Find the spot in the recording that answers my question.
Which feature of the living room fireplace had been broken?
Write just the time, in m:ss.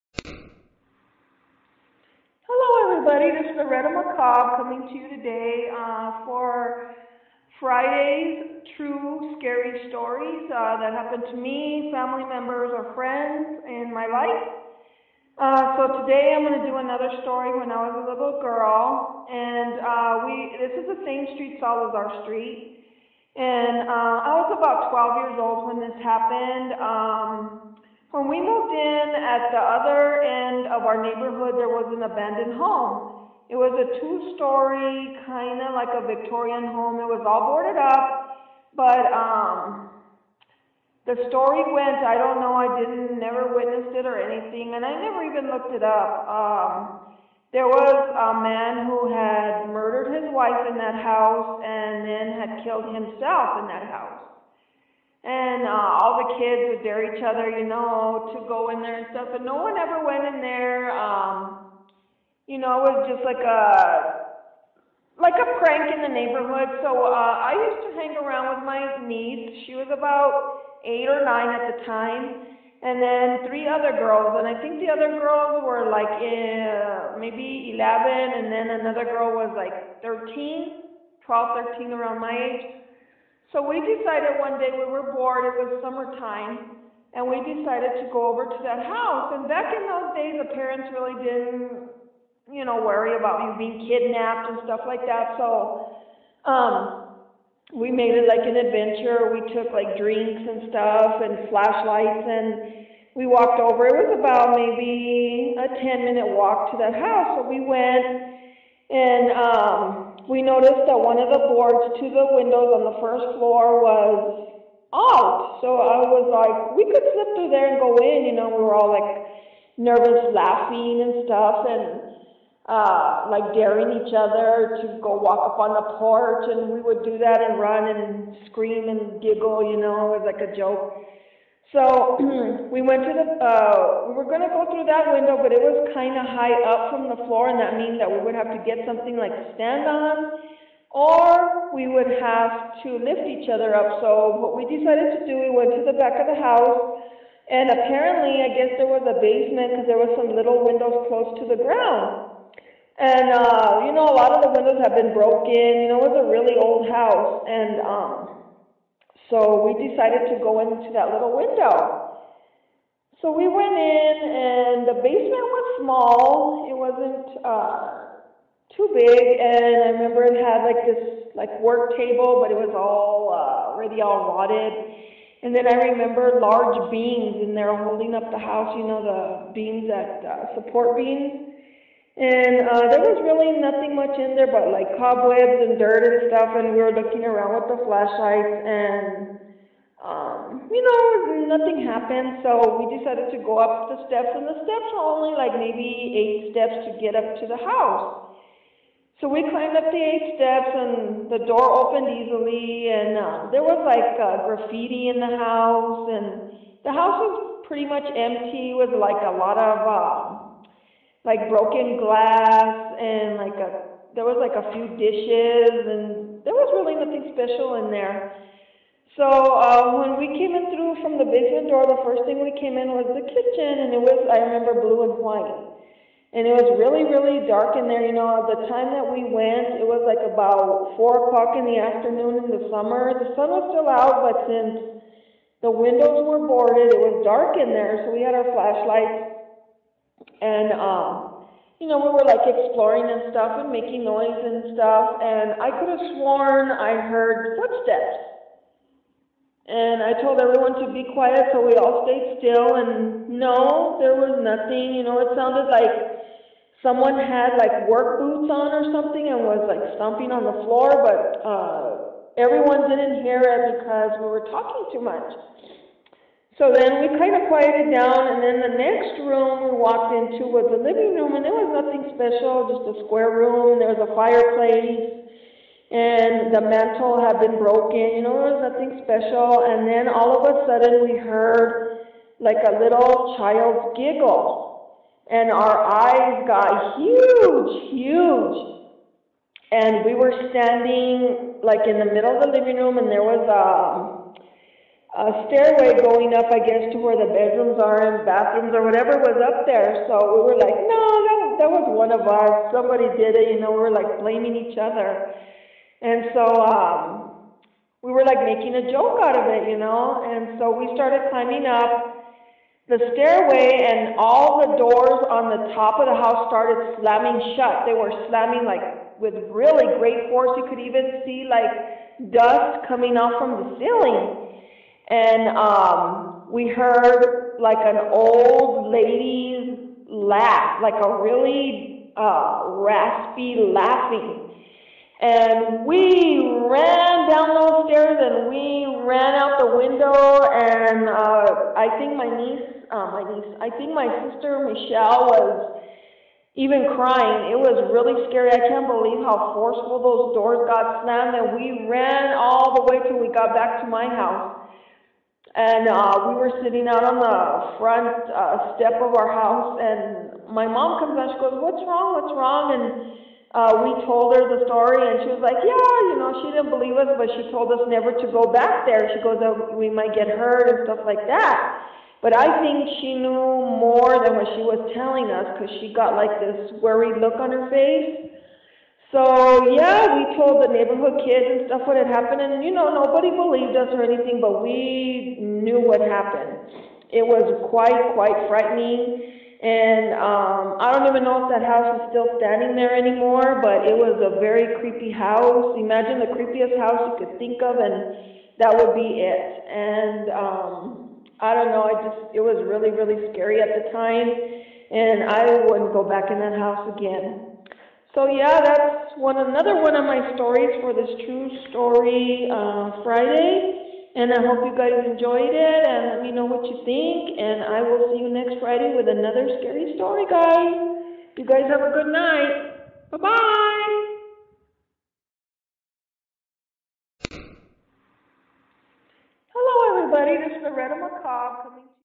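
4:36.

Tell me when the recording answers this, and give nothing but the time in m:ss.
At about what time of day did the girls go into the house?
3:50.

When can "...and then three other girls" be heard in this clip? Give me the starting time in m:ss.
1:12.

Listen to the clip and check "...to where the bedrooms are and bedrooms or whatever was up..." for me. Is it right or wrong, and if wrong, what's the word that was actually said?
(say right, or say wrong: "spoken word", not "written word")
wrong: "bathrooms", not "bedrooms".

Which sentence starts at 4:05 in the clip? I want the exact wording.
And I could have sworn I heard footsteps.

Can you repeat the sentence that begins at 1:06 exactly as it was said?
So uh, I used to hang around with my niece.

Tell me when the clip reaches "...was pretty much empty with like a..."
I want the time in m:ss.
3:27.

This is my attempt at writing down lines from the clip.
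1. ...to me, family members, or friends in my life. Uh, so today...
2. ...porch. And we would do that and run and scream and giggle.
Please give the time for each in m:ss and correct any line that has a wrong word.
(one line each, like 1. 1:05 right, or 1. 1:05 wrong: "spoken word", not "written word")
1. 0:11 right
2. 2:05 right.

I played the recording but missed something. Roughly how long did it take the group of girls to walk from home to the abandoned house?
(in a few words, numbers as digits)
10 minutes.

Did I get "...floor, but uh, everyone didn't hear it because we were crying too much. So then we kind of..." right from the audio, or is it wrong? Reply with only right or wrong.
wrong.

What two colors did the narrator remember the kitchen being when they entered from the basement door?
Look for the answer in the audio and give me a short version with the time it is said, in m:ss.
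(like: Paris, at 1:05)
Blue and white, at 3:44.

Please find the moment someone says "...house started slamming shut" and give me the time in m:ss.
5:16.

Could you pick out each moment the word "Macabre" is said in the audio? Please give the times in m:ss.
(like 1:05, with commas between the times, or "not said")
0:03, 7:10.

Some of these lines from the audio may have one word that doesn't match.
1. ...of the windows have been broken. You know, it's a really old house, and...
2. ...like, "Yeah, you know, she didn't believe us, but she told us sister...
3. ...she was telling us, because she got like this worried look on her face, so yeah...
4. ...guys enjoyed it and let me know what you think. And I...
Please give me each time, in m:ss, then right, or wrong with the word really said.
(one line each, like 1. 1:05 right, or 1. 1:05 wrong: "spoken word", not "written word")
1. 2:34 right
2. 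6:05 wrong: "never", not "sister"
3. 6:14 right
4. 6:54 right.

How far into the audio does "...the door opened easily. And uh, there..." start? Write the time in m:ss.
3:21.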